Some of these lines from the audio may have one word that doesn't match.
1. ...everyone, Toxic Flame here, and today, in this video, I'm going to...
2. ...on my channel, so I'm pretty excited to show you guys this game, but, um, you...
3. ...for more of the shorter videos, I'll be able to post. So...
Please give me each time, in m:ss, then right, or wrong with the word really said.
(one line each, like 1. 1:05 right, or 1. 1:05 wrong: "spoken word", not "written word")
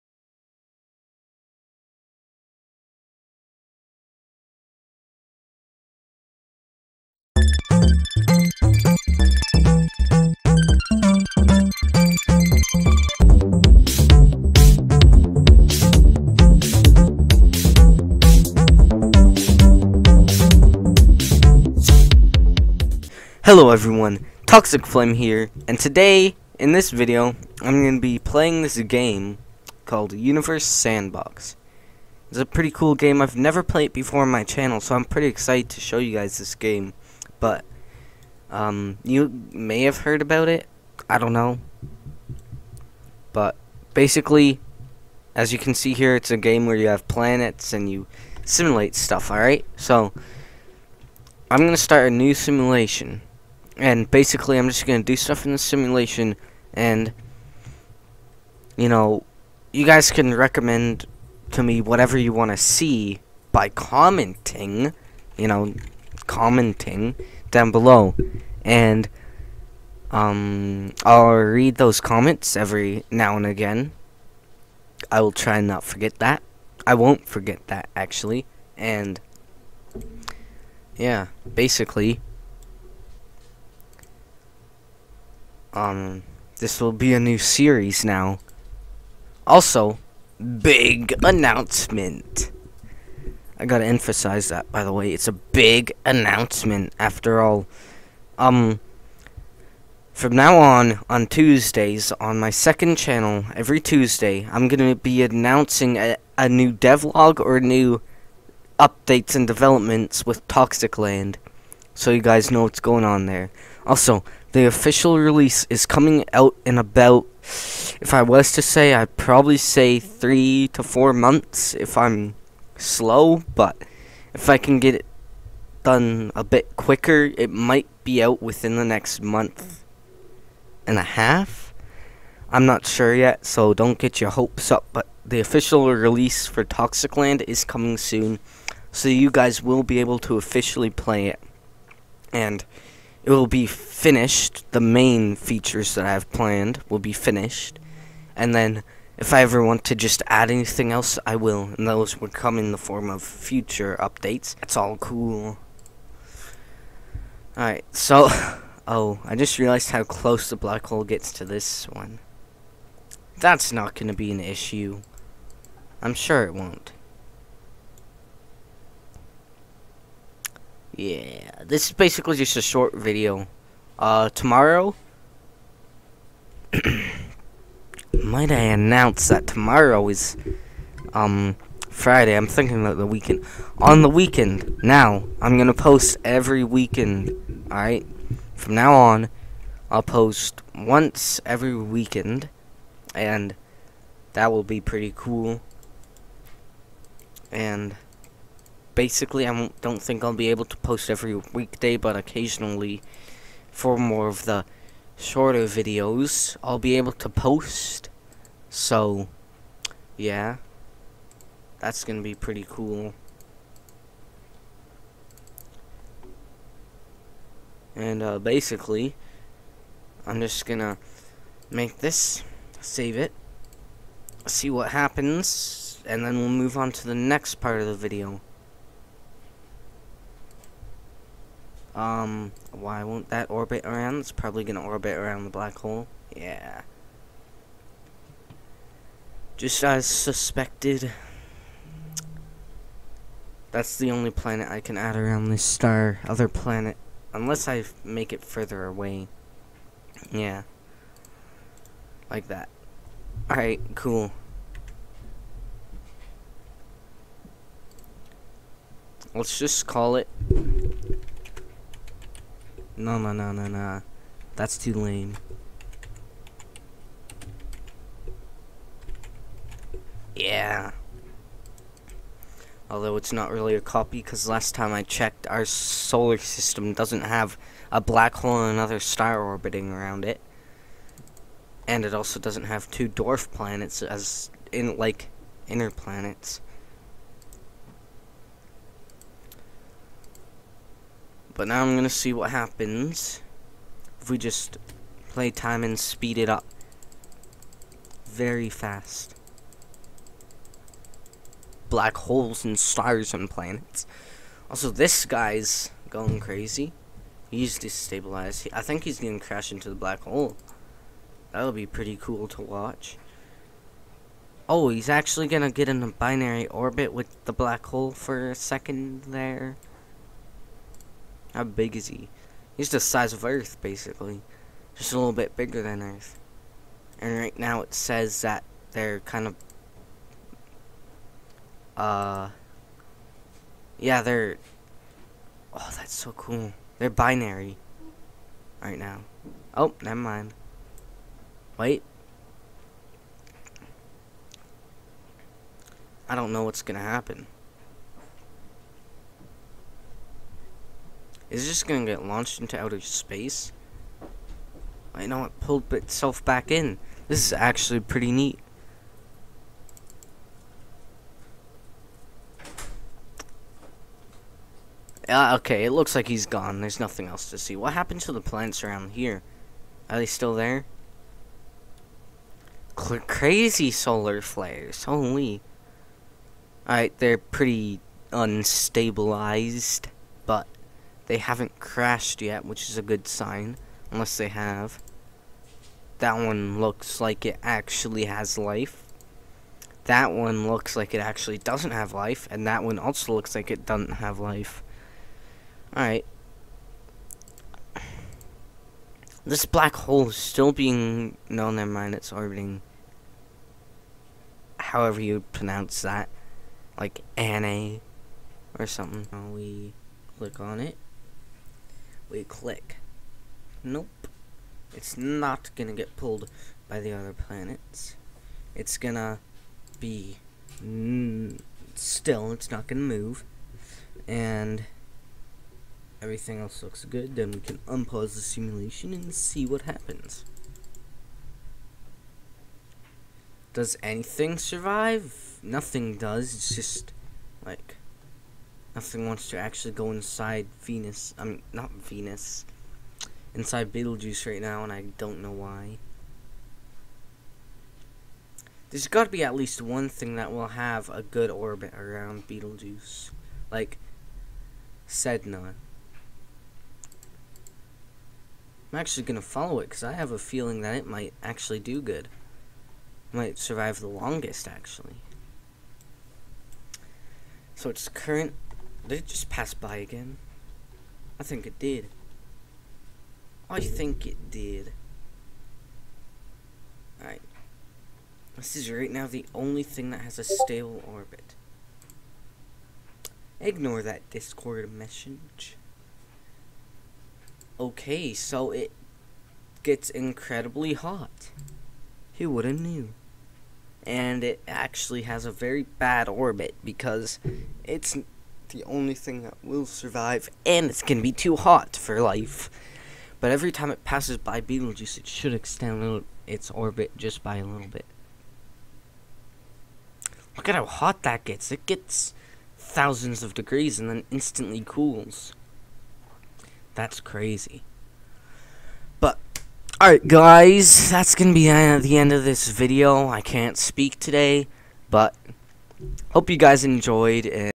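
1. 0:23 right
2. 0:34 right
3. 3:23 right.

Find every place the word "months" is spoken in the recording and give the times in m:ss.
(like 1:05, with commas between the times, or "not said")
2:01, 2:09.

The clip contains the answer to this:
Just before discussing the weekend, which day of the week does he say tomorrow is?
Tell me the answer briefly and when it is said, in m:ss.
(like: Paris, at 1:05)
Friday, at 3:01.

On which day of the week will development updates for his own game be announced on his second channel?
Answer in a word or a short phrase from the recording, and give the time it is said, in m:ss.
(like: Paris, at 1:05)
Tuesday, at 1:43.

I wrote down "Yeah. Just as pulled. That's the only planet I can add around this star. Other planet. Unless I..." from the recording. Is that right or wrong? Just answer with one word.
wrong.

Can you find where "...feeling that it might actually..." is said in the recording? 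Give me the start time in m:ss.
7:40.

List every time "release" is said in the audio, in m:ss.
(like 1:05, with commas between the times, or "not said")
1:55, 2:15.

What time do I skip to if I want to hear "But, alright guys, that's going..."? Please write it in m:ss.
8:39.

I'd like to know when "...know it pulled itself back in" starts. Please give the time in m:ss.
5:55.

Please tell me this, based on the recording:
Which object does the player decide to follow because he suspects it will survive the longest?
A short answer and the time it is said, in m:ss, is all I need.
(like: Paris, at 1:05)
Sedna, at 7:35.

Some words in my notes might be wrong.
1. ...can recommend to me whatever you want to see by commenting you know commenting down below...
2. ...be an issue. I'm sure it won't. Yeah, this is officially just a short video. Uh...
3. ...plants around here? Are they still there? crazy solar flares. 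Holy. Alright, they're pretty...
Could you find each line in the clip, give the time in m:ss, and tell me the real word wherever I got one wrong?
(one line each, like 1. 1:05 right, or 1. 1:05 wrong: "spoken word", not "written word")
1. 1:00 right
2. 2:44 wrong: "basically", not "officially"
3. 6:08 right.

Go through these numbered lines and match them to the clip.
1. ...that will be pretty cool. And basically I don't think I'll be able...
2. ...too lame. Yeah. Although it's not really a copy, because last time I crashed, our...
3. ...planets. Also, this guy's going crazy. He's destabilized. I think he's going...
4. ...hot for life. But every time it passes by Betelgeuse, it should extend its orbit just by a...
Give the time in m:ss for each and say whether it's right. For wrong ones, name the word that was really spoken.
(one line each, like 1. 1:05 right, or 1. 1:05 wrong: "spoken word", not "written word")
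1. 3:14 right
2. 4:24 wrong: "checked", not "crashed"
3. 5:03 right
4. 8:21 right.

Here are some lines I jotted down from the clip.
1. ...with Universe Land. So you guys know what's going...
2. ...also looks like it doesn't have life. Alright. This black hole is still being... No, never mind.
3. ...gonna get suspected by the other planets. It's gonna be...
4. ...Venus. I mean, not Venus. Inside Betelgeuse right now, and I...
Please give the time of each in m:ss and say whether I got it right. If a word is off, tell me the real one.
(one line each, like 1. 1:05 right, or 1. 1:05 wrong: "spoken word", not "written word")
1. 1:50 wrong: "Toxic", not "Universe"
2. 6:32 right
3. 6:55 wrong: "pulled", not "suspected"
4. 7:20 right.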